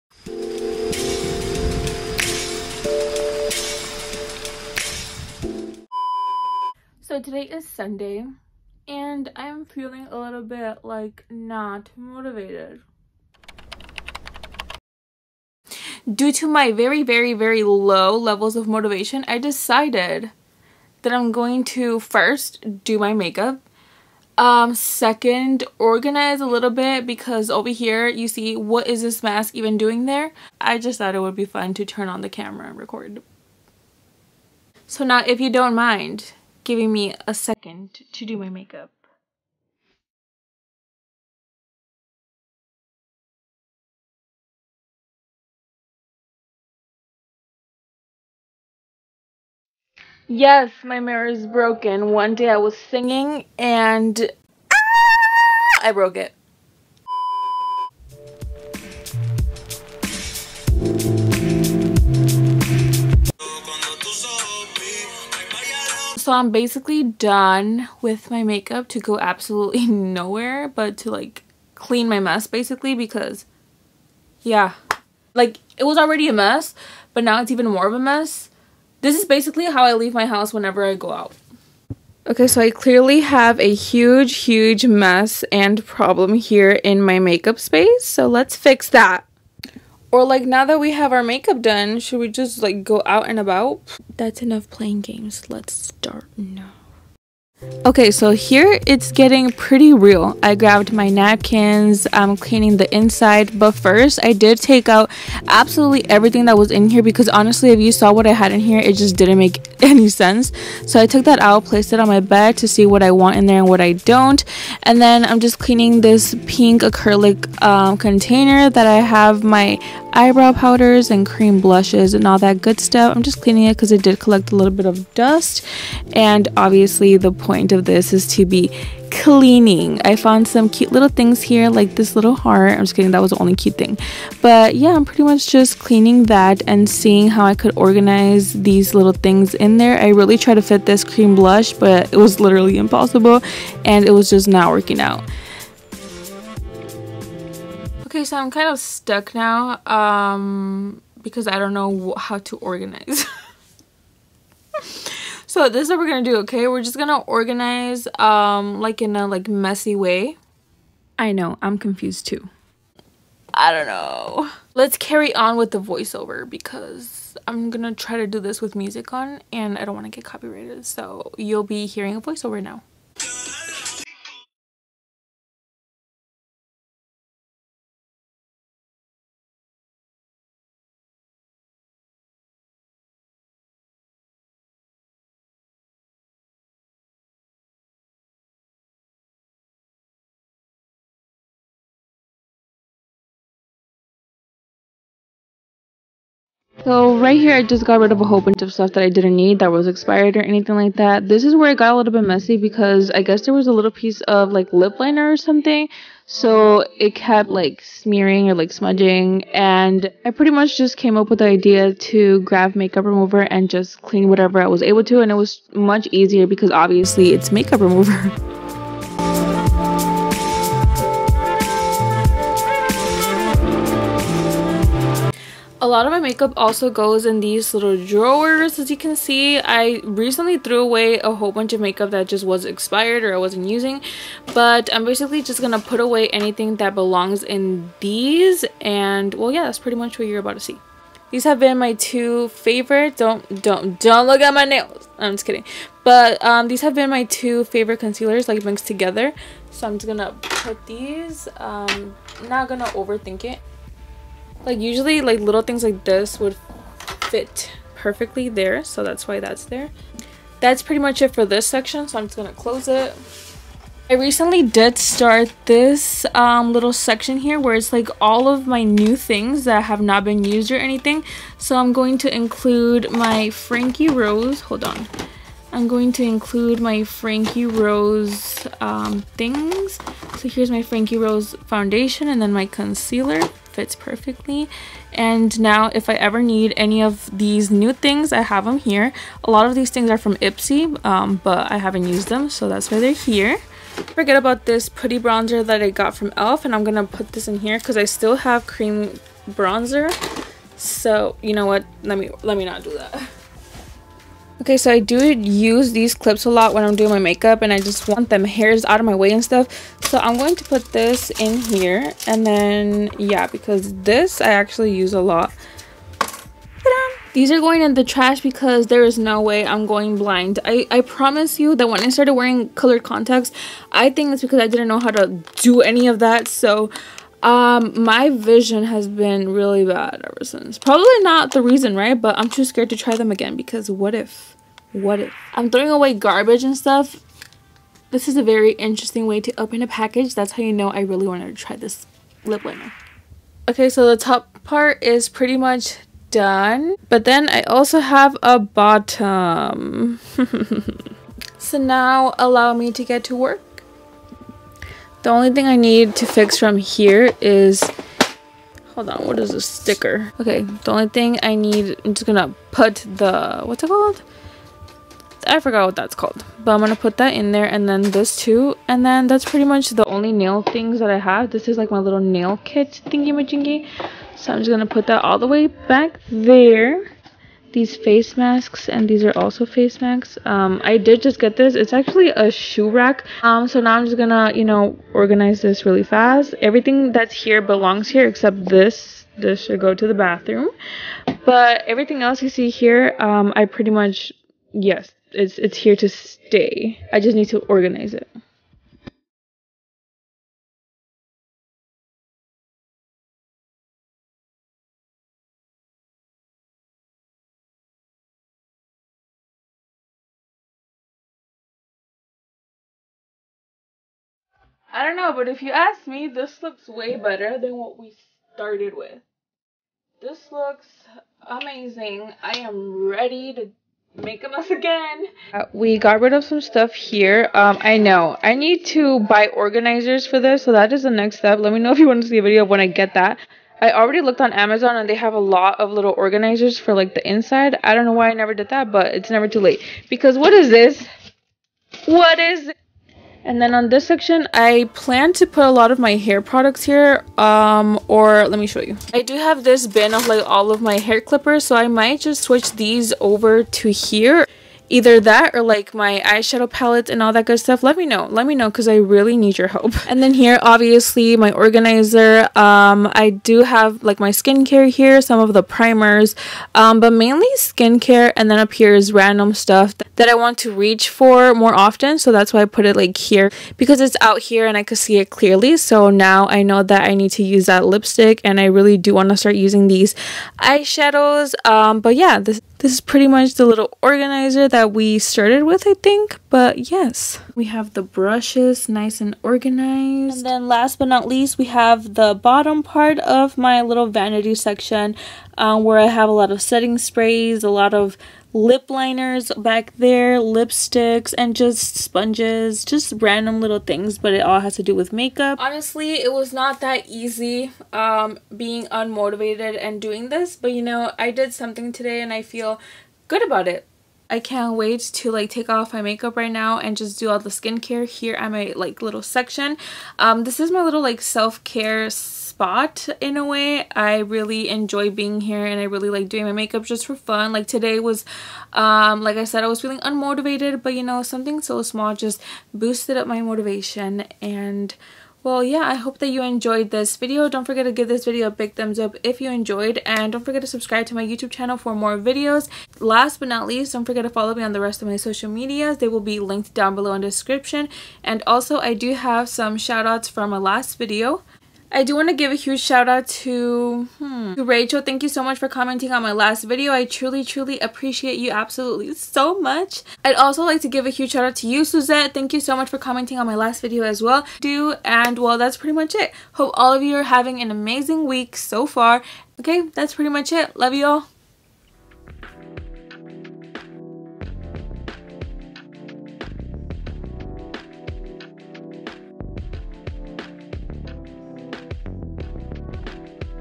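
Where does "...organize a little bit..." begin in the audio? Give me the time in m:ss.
0:25.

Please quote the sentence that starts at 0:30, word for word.
I just thought it would be fun to turn on the camera and record.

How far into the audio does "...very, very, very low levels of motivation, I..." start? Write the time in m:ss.
0:16.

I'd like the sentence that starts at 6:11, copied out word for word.
This is like my little nail kit thingy majingy.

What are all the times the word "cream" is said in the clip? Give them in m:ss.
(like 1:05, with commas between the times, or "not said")
2:01, 2:21, 4:58.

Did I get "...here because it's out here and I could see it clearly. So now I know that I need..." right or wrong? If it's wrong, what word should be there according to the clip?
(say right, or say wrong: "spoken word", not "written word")
right.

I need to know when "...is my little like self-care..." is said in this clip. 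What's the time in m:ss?
8:40.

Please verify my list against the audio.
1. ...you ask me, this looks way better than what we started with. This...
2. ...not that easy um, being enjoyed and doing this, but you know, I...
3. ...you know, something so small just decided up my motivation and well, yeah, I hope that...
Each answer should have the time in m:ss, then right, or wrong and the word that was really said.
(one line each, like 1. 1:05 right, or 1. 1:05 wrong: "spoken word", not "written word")
1. 6:55 right
2. 8:26 wrong: "unmotivated", not "enjoyed"
3. 8:50 wrong: "boosted", not "decided".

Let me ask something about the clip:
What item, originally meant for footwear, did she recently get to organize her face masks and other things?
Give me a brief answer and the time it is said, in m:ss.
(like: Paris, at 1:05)
Shoe rack, at 6:22.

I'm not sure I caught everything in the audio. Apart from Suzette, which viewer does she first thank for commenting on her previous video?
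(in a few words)
Rachel.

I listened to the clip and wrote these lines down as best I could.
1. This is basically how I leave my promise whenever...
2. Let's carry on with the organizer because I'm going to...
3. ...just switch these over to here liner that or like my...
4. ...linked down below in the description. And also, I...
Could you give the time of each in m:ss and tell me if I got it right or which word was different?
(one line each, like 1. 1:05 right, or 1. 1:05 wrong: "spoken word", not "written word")
1. 1:19 wrong: "house", not "promise"
2. 2:44 wrong: "voiceover", not "organizer"
3. 7:32 wrong: "either", not "liner"
4. 9:06 right.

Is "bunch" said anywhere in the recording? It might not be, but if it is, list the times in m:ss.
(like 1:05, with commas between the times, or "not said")
3:18, 3:51.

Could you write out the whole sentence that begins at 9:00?
And don't forget to subscribe to my YouTube channel for more videos.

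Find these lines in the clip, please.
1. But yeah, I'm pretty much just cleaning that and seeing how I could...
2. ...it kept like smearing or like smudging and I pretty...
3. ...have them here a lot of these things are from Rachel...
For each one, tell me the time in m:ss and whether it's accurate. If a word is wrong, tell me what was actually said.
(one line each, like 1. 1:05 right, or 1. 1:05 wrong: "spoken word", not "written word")
1. 2:14 right
2. 3:26 right
3. 4:48 wrong: "Ipsy", not "Rachel".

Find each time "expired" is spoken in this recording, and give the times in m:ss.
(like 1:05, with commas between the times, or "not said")
3:19, 3:52.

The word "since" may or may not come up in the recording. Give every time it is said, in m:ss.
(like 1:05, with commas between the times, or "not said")
5:30.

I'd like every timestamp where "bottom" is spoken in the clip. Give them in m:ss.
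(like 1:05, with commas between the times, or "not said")
5:48, 8:12.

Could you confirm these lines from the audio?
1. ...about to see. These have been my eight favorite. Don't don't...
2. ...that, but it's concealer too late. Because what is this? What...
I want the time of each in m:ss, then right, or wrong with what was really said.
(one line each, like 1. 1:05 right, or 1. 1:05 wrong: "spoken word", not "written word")
1. 4:00 wrong: "two", not "eight"
2. 7:18 wrong: "never", not "concealer".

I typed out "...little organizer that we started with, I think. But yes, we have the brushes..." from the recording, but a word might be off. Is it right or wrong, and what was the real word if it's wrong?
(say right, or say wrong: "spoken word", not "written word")
right.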